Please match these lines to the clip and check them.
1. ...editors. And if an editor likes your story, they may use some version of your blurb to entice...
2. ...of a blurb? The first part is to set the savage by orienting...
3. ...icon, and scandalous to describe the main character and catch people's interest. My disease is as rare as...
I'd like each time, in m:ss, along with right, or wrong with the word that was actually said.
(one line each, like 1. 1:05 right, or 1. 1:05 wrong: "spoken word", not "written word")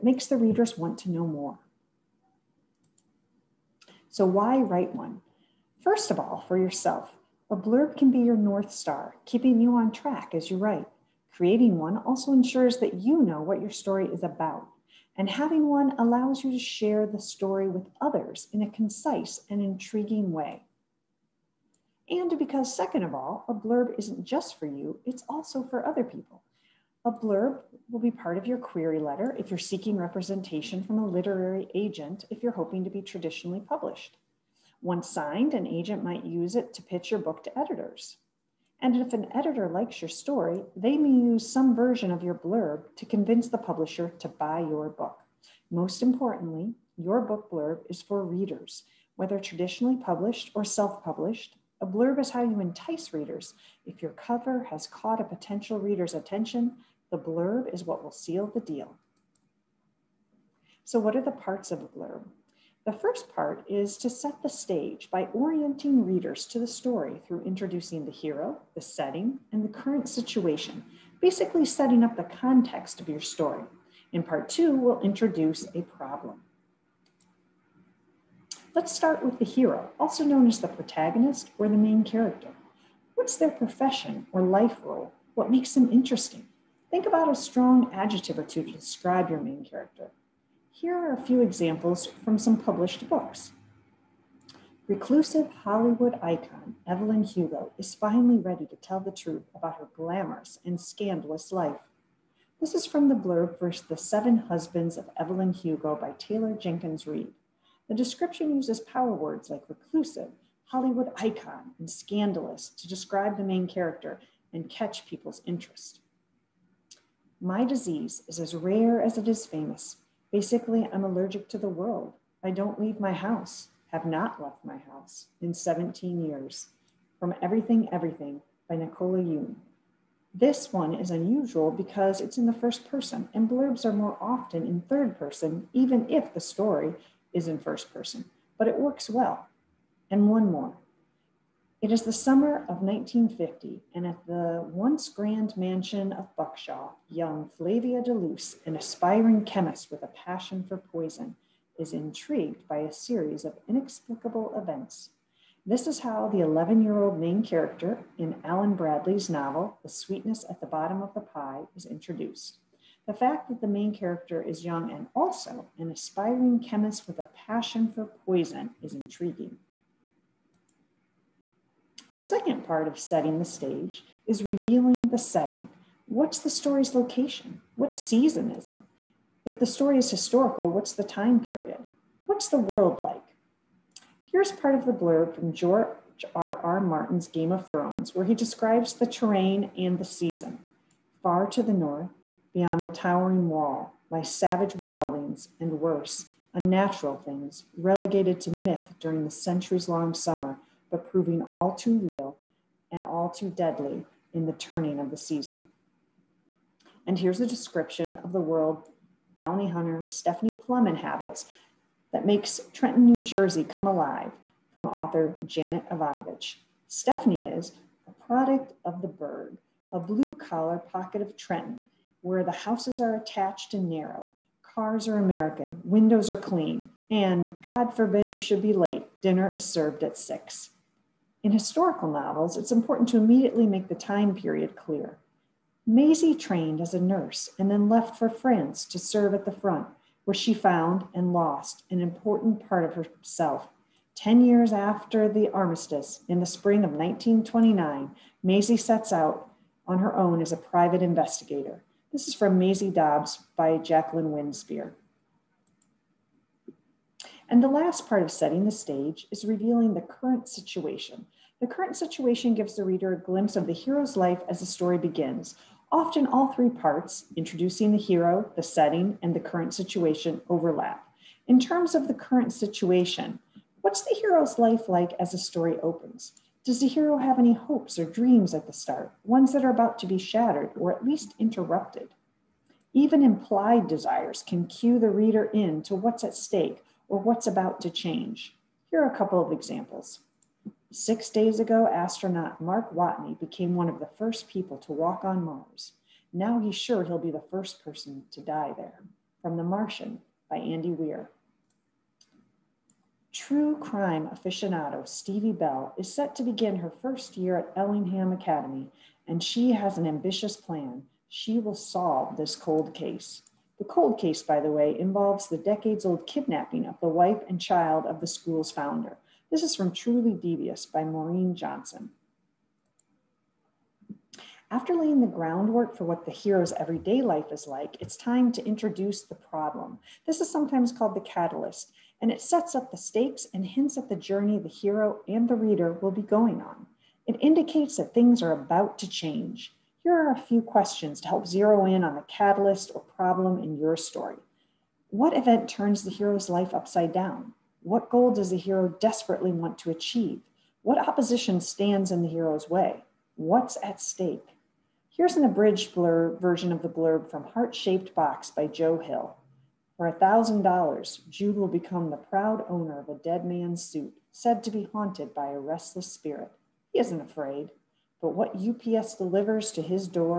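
1. 0:37 wrong: "convince", not "entice"
2. 1:01 wrong: "stage", not "savage"
3. 1:51 right.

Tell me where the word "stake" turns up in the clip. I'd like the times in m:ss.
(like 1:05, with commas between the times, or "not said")
4:46, 5:32, 5:54.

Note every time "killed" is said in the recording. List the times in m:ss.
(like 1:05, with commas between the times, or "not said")
not said.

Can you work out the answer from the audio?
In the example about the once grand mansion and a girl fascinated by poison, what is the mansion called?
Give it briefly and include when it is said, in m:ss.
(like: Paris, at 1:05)
Buckshaw, at 2:26.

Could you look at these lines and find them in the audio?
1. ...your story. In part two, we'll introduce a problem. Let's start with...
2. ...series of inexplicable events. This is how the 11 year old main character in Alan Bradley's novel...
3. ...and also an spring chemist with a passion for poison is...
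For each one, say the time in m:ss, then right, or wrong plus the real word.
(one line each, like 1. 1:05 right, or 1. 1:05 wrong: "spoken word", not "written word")
1. 1:13 right
2. 2:32 right
3. 2:44 wrong: "aspiring", not "spring".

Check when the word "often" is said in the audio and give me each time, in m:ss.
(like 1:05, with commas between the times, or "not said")
2:14, 4:25.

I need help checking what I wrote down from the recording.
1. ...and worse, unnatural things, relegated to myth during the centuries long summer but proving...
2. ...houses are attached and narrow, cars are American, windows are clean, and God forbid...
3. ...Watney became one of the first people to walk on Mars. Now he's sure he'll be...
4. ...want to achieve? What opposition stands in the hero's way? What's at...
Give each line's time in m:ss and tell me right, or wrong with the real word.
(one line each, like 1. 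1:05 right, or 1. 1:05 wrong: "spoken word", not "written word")
1. 3:15 right
2. 3:42 right
3. 4:52 right
4. 5:49 right.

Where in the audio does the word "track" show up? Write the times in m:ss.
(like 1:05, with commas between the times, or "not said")
0:09.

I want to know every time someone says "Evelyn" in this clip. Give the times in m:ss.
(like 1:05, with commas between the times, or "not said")
1:36, 1:45.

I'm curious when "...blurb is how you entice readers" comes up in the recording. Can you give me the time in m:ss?
0:51.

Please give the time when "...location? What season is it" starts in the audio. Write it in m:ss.
2:56.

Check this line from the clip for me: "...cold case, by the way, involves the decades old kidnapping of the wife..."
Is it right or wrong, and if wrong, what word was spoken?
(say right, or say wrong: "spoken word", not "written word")
right.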